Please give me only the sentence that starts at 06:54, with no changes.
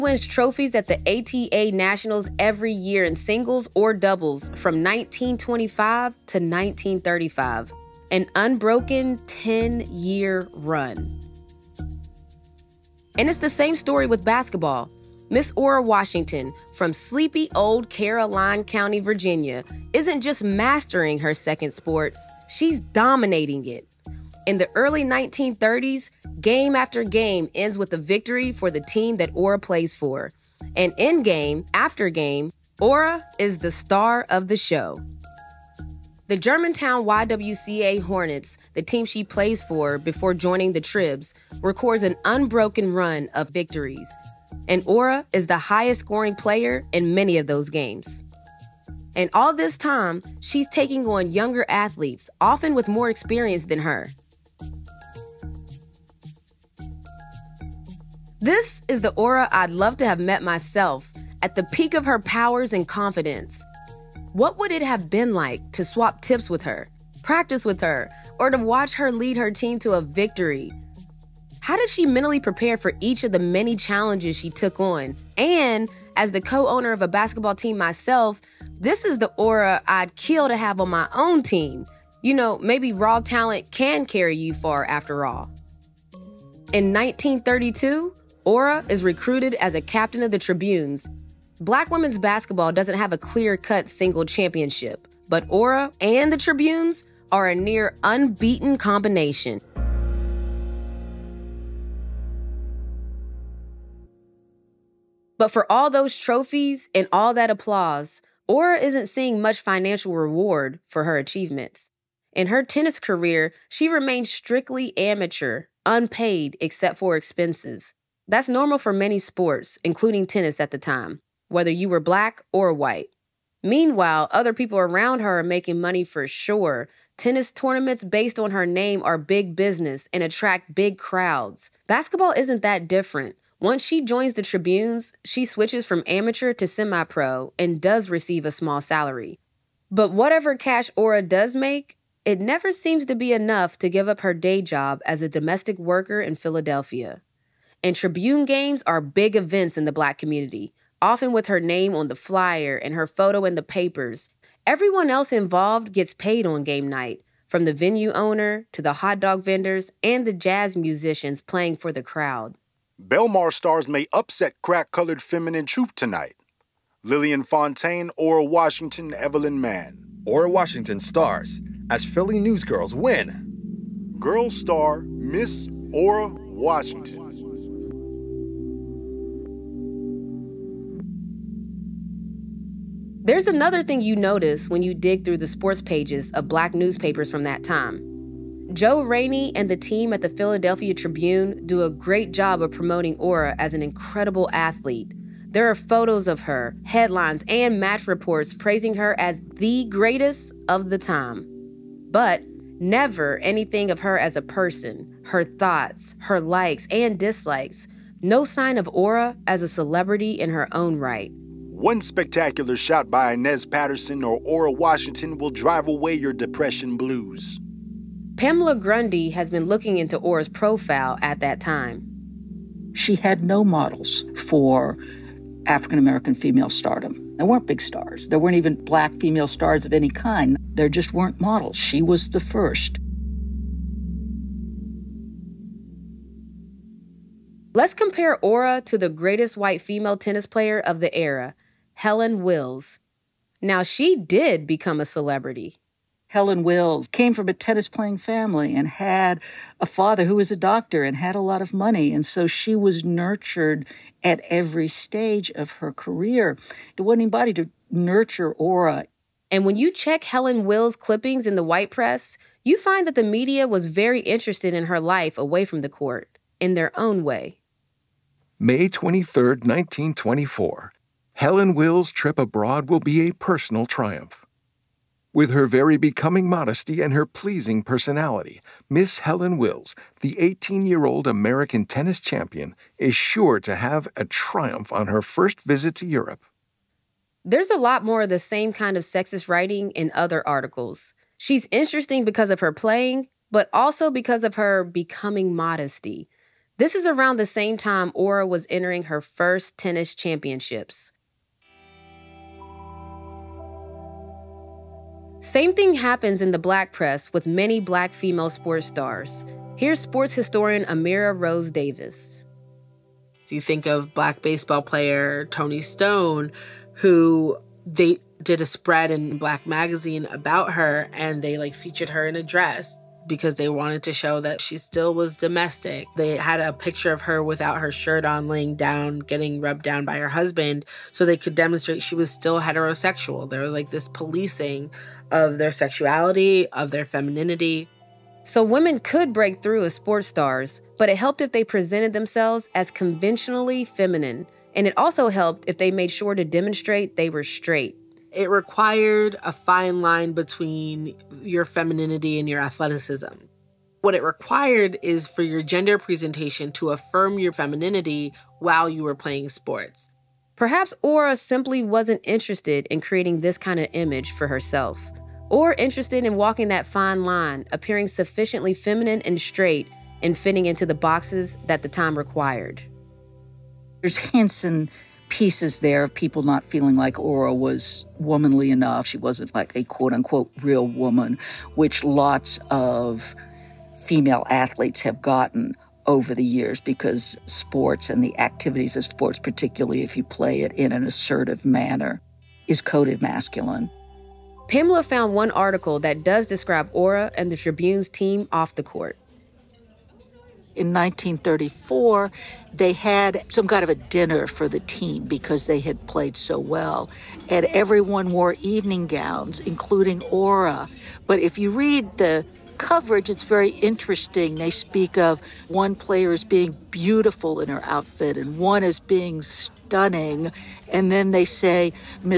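They speak of one player as being beautiful in her outfit and one as being stunning.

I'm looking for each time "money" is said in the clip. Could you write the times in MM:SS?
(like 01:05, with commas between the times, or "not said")
02:05, 04:11.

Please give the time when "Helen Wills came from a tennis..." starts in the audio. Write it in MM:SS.
04:06.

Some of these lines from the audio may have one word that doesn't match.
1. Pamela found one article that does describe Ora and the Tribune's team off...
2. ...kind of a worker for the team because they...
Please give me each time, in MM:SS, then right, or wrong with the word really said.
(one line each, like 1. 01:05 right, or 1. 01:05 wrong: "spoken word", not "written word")
1. 06:34 right
2. 06:43 wrong: "dinner", not "worker".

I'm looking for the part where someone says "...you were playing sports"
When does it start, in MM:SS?
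05:58.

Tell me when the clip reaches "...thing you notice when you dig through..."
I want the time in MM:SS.
03:03.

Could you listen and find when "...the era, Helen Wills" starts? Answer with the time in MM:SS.
04:00.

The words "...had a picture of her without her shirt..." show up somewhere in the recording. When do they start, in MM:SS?
05:26.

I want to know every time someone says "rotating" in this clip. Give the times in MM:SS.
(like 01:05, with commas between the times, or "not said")
not said.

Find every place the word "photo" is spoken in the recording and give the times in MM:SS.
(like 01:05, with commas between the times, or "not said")
02:33, 03:15.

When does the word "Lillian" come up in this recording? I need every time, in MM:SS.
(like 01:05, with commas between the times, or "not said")
02:47.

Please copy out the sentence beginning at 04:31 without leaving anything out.
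Helen Will's trip abroad will be a personal triumph.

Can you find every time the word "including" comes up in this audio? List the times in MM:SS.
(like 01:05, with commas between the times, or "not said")
01:59, 06:49.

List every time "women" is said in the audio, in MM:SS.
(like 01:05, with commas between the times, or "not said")
01:31, 05:38.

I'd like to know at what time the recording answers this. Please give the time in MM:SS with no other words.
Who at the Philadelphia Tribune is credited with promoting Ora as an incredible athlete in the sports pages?
03:08.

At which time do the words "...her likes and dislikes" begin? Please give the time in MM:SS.
03:26.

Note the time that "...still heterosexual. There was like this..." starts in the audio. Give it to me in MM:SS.
05:32.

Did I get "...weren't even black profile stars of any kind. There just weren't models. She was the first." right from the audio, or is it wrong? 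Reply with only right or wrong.
wrong.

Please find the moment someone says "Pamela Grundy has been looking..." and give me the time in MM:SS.
03:38.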